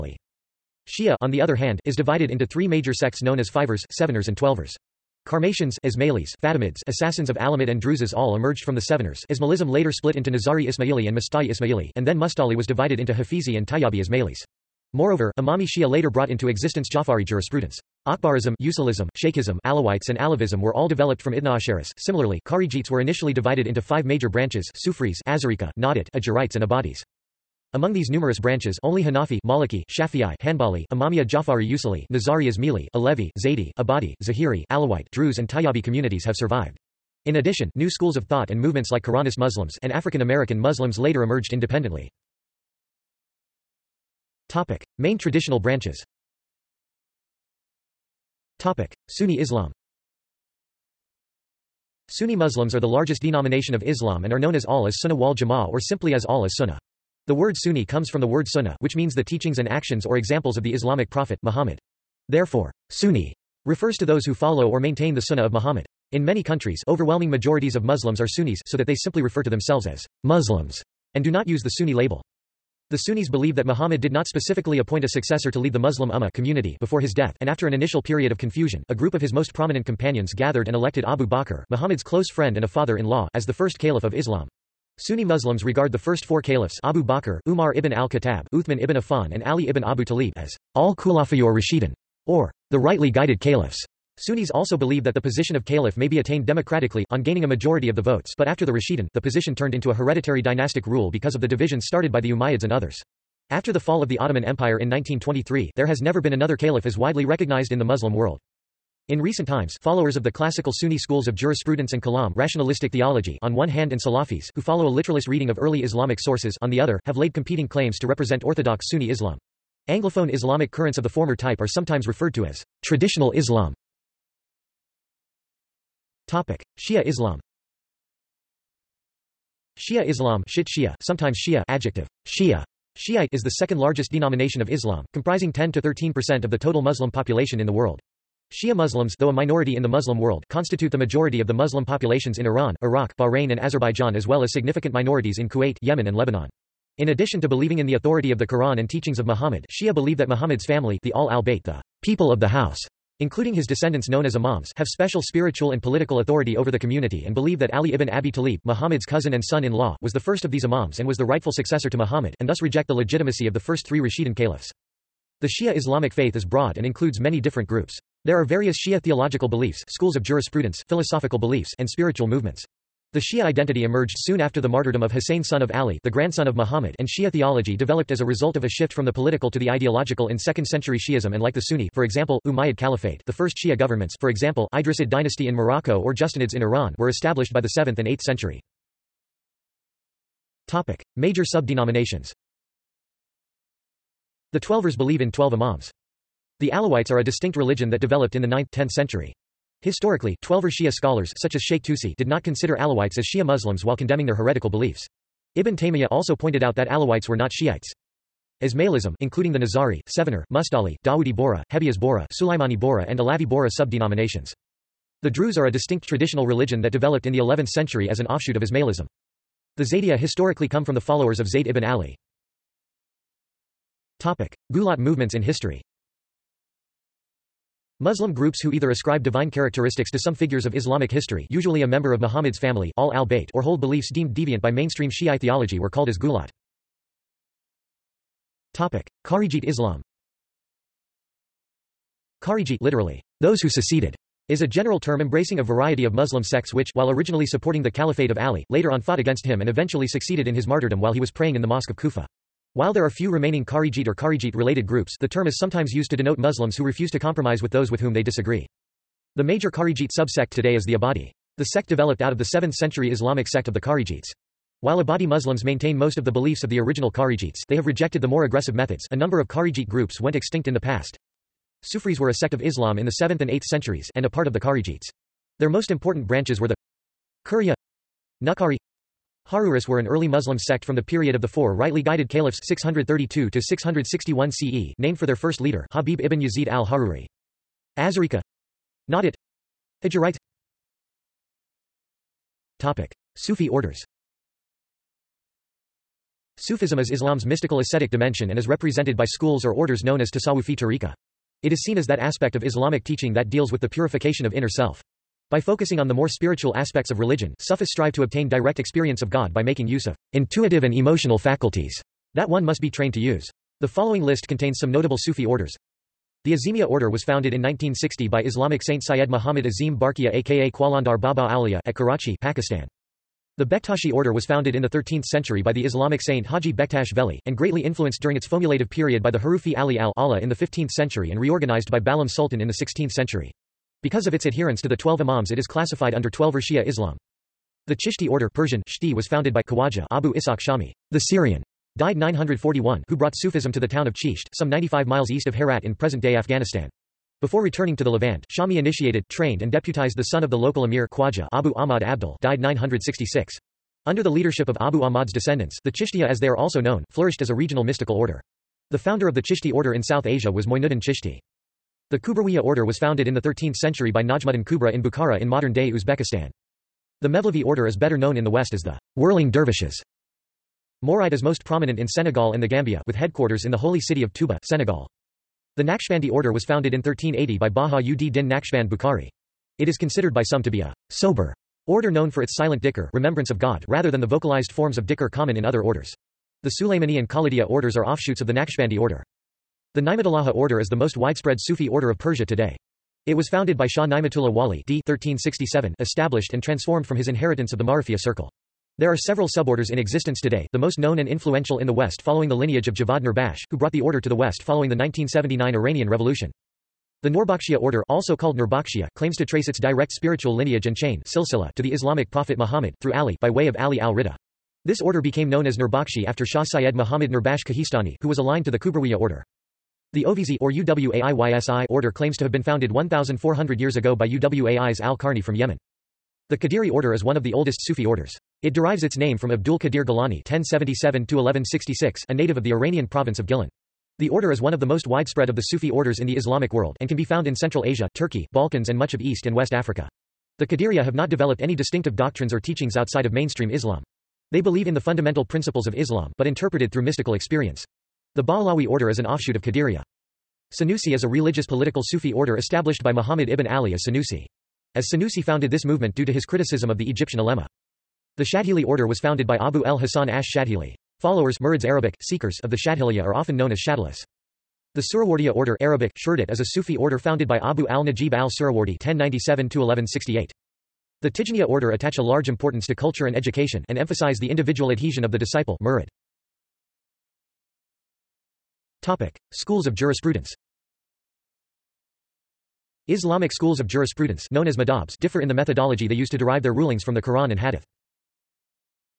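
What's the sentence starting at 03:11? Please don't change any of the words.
Major sub-denominations The Twelvers believe in twelve imams.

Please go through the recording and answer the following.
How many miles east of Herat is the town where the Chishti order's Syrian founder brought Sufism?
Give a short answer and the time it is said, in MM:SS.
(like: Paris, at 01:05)
95, at 05:44.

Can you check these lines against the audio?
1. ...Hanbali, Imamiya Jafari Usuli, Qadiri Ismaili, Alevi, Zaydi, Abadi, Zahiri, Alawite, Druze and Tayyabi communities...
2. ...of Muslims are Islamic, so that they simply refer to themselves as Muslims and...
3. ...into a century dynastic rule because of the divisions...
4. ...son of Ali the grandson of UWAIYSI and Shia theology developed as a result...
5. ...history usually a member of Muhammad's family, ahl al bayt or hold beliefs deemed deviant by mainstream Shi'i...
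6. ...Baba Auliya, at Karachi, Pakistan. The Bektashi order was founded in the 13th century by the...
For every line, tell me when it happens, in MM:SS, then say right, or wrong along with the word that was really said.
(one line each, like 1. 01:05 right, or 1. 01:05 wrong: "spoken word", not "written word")
1. 00:30 wrong: "Nizari", not "Qadiri"
2. 01:07 wrong: "Sunnis", not "Islamic"
3. 01:39 wrong: "hereditary", not "century"
4. 02:55 wrong: "Muhammad", not "UWAIYSI"
5. 03:51 right
6. 05:21 right.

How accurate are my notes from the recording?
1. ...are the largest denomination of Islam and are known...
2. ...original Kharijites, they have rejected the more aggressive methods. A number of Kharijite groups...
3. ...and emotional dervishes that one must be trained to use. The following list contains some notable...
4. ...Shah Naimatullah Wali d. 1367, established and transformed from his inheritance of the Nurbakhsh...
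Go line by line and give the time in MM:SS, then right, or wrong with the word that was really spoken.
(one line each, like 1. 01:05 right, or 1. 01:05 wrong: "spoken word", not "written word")
1. 00:52 right
2. 04:26 right
3. 05:10 wrong: "faculties", not "dervishes"
4. 06:33 wrong: "Marifia", not "Nurbakhsh".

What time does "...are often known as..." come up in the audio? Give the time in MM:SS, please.
07:43.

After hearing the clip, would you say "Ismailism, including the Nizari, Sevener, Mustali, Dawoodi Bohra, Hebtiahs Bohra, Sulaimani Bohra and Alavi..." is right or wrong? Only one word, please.
right.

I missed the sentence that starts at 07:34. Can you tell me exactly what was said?
As Sanusi founded this movement due to his criticism of the Egyptian ulema.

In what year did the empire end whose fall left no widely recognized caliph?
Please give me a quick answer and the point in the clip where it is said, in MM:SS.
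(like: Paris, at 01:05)
1923, at 01:44.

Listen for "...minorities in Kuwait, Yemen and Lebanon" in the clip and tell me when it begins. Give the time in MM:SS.
02:24.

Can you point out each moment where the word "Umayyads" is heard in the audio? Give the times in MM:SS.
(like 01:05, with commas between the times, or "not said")
01:42, 03:02.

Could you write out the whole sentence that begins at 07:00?
The Oveysi or UWAIYSI order claims to have been founded 1,400 years ago by UWAI's al-Qarni from Yemen.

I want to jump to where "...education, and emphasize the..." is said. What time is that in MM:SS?
07:53.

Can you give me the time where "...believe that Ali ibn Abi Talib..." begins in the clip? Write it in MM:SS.
02:37.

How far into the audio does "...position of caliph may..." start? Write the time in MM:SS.
01:35.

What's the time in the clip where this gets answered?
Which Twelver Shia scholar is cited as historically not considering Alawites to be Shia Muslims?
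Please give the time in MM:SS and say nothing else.
03:21.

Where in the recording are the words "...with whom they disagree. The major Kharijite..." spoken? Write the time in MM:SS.
04:17.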